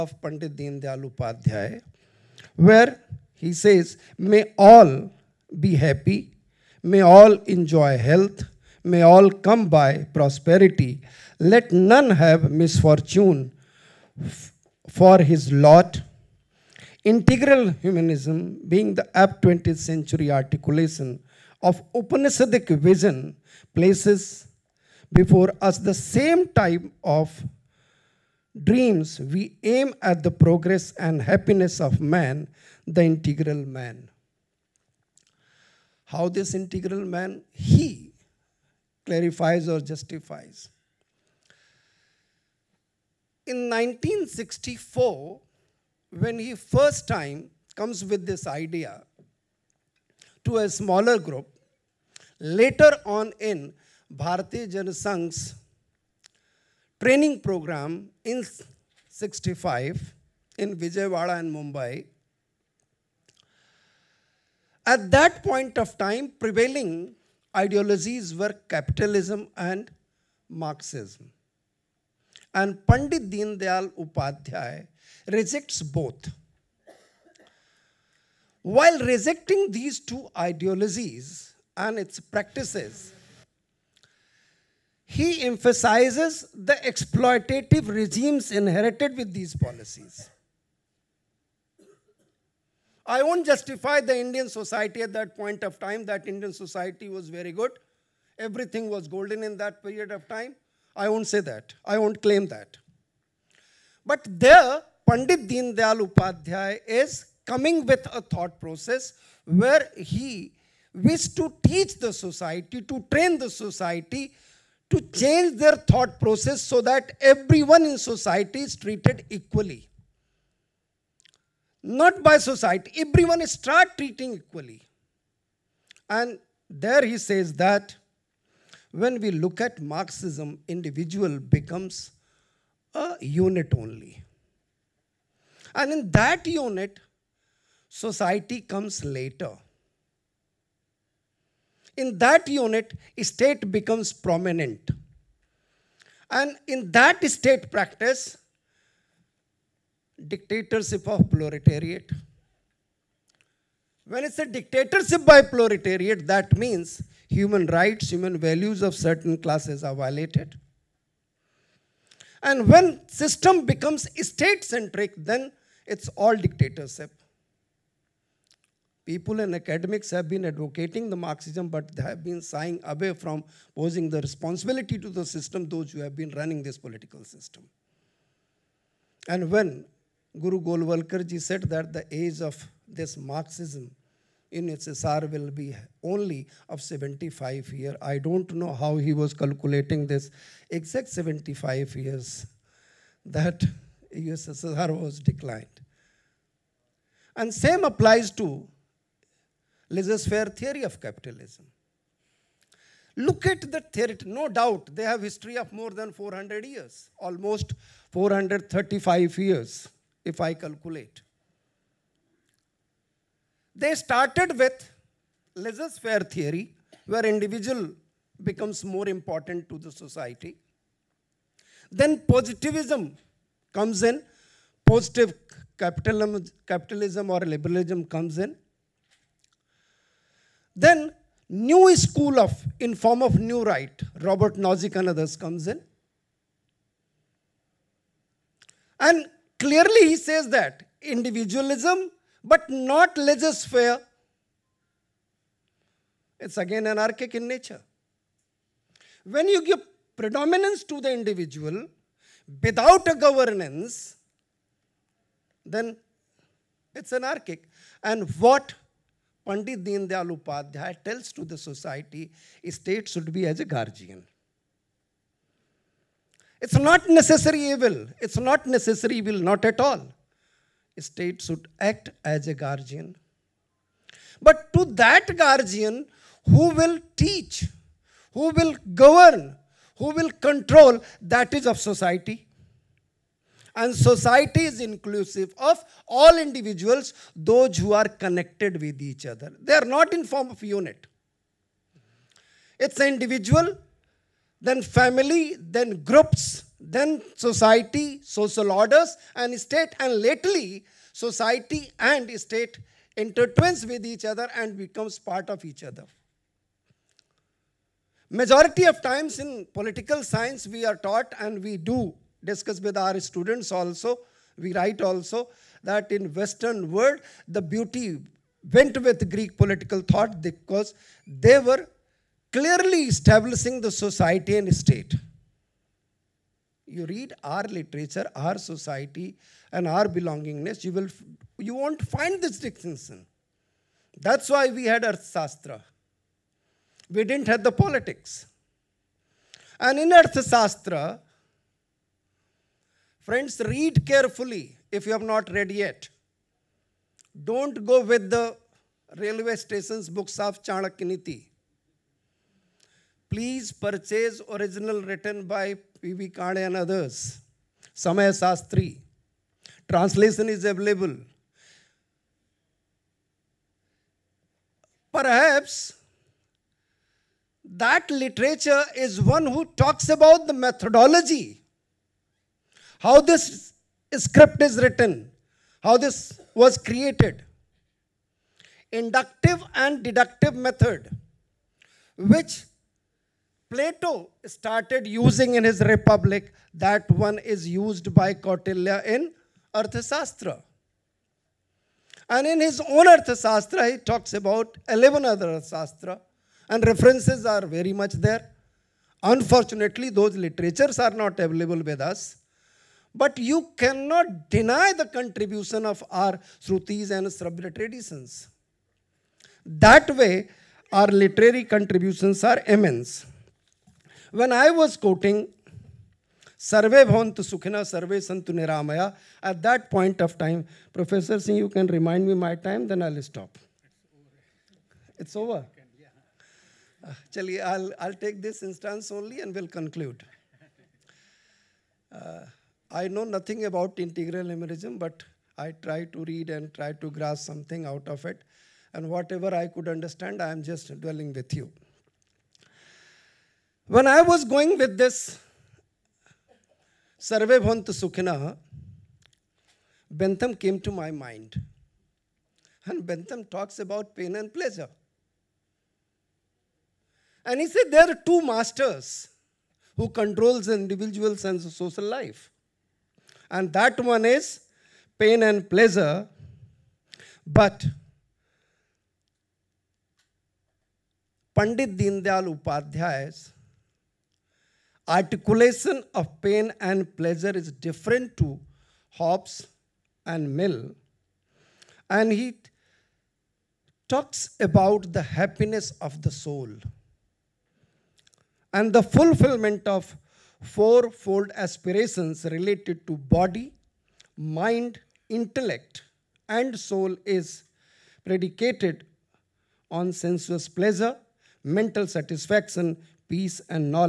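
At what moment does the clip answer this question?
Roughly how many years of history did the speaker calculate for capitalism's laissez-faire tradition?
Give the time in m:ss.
3:28.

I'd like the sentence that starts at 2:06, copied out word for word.
And there he says that when we look at Marxism, individual becomes a unit only.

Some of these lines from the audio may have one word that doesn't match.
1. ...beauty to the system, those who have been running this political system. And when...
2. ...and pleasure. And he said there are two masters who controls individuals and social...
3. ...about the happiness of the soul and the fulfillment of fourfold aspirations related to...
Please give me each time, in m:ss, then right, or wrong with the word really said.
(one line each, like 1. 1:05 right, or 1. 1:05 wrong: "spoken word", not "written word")
1. 2:54 wrong: "responsibility", not "beauty"
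2. 7:34 right
3. 8:04 right.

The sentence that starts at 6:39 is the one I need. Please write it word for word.
Unfortunately, those literatures are not available with us.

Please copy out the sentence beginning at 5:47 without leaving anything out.
Don't go with the railway stations books of Chanakya Please purchase original written by P.V.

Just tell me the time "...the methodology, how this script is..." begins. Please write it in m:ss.
6:10.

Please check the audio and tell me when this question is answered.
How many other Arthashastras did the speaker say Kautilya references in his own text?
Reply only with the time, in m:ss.
6:34.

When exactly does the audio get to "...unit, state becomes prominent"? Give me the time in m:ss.
2:22.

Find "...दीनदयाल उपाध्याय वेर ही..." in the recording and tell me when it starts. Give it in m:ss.
0:00.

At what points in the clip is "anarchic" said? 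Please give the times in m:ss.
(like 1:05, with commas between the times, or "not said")
4:06, 4:17.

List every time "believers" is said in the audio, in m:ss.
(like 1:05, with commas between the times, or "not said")
not said.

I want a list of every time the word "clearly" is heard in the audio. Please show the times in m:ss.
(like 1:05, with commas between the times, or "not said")
3:59, 5:22.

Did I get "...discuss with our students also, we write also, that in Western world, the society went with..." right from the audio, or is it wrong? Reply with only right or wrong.
wrong.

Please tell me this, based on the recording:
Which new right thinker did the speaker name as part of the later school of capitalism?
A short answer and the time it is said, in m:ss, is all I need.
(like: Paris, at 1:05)
Robert Nozick, at 3:54.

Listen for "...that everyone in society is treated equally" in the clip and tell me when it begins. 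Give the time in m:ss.
1:56.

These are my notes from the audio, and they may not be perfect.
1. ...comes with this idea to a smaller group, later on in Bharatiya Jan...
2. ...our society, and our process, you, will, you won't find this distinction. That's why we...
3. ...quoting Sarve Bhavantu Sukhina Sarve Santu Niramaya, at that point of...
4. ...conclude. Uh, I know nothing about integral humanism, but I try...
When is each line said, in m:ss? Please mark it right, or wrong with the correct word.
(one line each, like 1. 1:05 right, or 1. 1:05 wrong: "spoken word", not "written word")
1. 0:47 right
2. 5:28 wrong: "belongingness", not "process"
3. 6:54 right
4. 7:09 right.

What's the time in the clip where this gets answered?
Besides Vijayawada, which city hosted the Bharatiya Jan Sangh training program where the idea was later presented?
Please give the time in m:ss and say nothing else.
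1:01.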